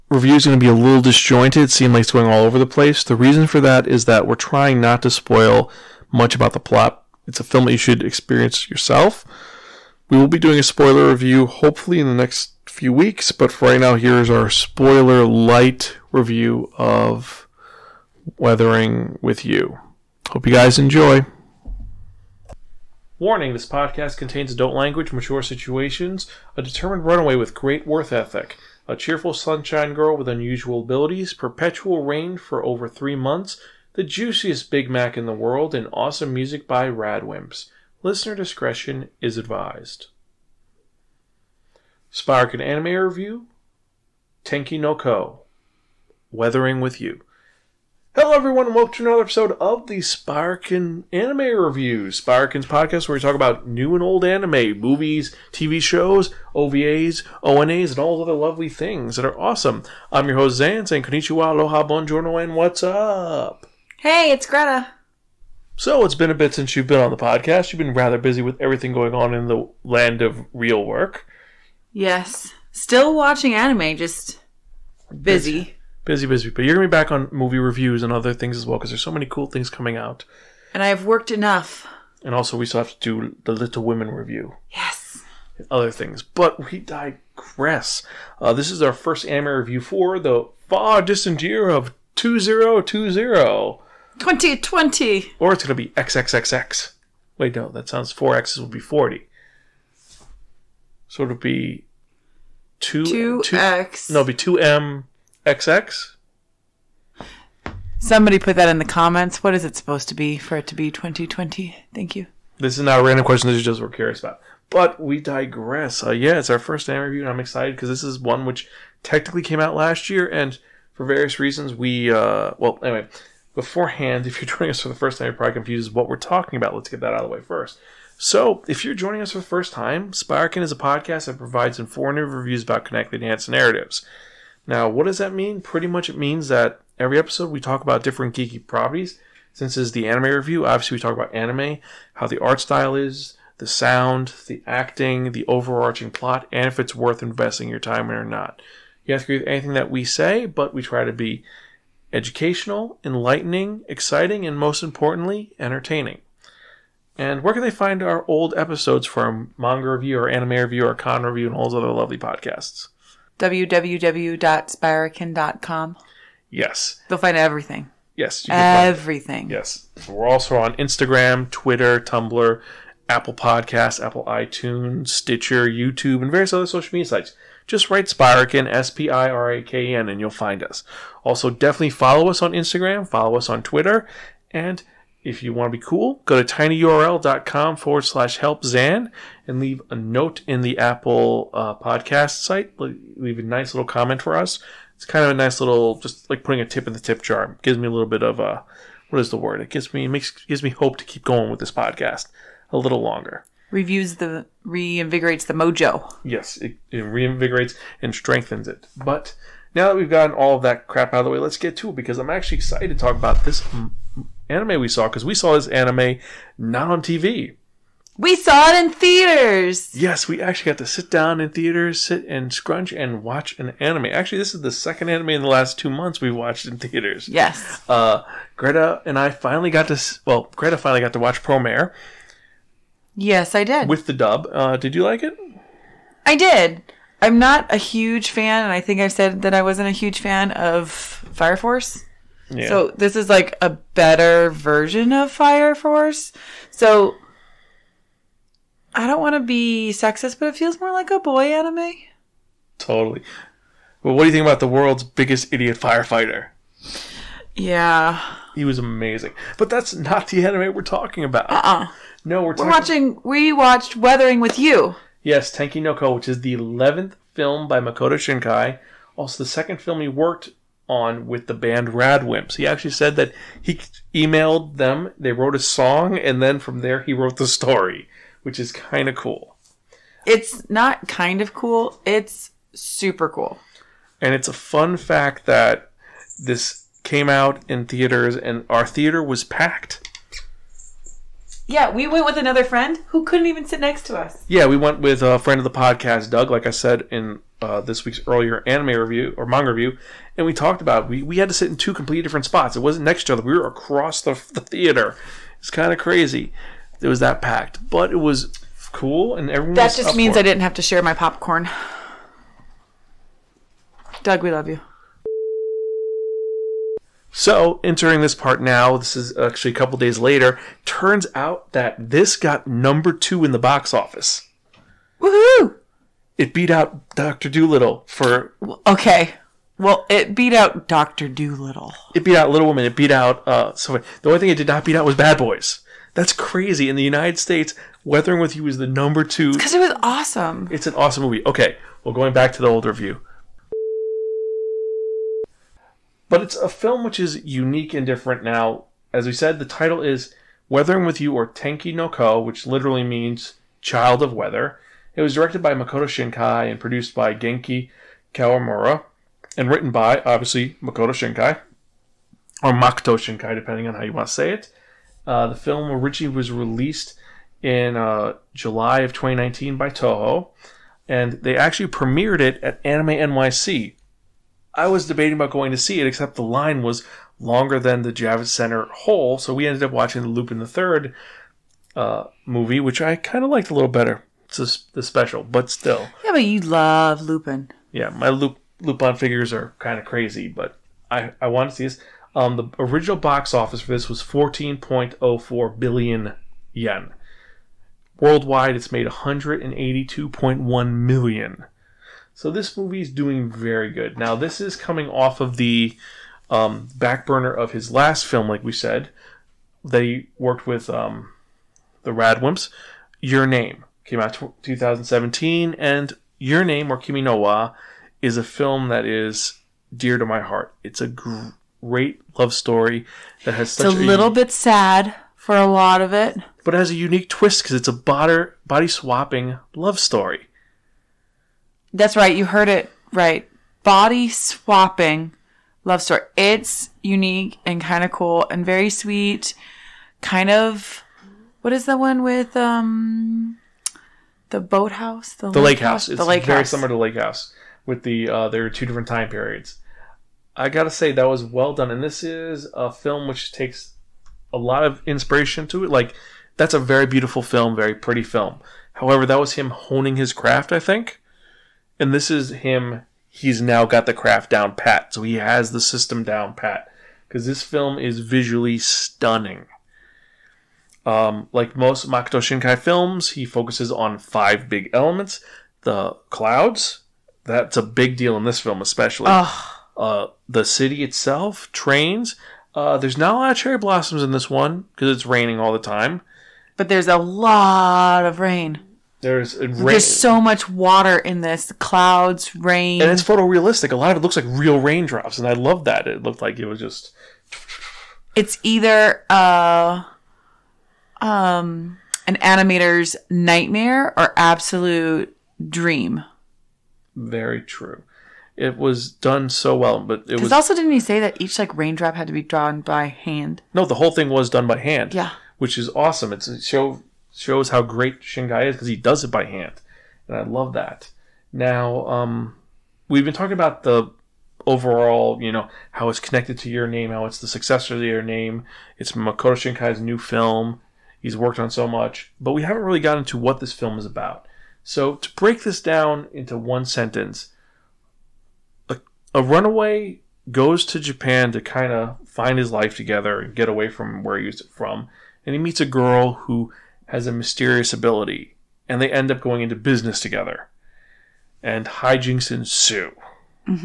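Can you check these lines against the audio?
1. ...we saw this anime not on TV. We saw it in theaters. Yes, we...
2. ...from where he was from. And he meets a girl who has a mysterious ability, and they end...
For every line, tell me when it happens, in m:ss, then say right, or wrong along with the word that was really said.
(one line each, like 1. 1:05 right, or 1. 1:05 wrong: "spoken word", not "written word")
1. 3:35 right
2. 9:03 right.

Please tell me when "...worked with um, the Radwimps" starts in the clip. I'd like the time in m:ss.
6:50.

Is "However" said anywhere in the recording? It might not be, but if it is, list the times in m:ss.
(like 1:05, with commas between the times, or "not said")
7:38.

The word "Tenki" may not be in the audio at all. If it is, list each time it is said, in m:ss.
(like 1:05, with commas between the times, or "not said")
0:44, 4:25, 5:51.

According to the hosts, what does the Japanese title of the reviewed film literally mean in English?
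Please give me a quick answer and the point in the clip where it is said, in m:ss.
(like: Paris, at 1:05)
Child of Weather, at 5:53.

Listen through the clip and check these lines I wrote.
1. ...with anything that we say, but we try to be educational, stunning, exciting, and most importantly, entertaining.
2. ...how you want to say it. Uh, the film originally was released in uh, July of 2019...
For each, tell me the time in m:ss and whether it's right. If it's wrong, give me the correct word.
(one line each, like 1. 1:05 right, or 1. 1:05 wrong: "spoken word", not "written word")
1. 2:29 wrong: "enlightening", not "stunning"
2. 6:03 right.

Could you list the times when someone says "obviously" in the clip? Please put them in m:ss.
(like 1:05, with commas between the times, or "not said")
2:20, 6:00.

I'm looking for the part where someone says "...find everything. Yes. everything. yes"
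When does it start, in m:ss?
2:47.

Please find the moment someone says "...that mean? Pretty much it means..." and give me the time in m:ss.
2:15.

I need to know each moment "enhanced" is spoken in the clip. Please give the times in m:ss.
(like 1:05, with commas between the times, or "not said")
2:13.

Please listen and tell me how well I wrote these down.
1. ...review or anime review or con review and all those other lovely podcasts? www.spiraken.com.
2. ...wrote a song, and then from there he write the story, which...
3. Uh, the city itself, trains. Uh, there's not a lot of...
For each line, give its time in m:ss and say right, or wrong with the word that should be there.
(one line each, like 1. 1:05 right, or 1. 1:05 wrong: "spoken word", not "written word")
1. 2:39 right
2. 4:35 wrong: "wrote", not "write"
3. 7:59 right.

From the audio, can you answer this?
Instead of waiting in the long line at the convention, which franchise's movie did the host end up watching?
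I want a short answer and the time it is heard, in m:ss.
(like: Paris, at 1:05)
Lupin the Third, at 6:20.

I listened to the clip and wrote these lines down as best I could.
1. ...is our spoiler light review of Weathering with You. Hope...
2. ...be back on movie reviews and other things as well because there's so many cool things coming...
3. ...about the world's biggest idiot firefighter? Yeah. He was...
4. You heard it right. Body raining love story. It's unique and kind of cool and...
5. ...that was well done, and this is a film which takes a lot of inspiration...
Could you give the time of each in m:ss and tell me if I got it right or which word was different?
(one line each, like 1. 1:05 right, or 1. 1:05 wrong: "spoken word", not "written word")
1. 0:14 right
2. 1:16 right
3. 4:14 right
4. 7:12 wrong: "swapping", not "raining"
5. 7:31 right.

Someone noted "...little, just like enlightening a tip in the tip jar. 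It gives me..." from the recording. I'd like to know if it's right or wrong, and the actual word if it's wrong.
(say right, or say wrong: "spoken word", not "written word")
wrong: "putting", not "enlightening".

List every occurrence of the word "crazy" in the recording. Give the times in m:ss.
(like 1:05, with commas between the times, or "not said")
5:05, 5:36, 6:30.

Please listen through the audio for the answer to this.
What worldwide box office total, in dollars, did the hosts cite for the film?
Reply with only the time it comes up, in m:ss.
6:39.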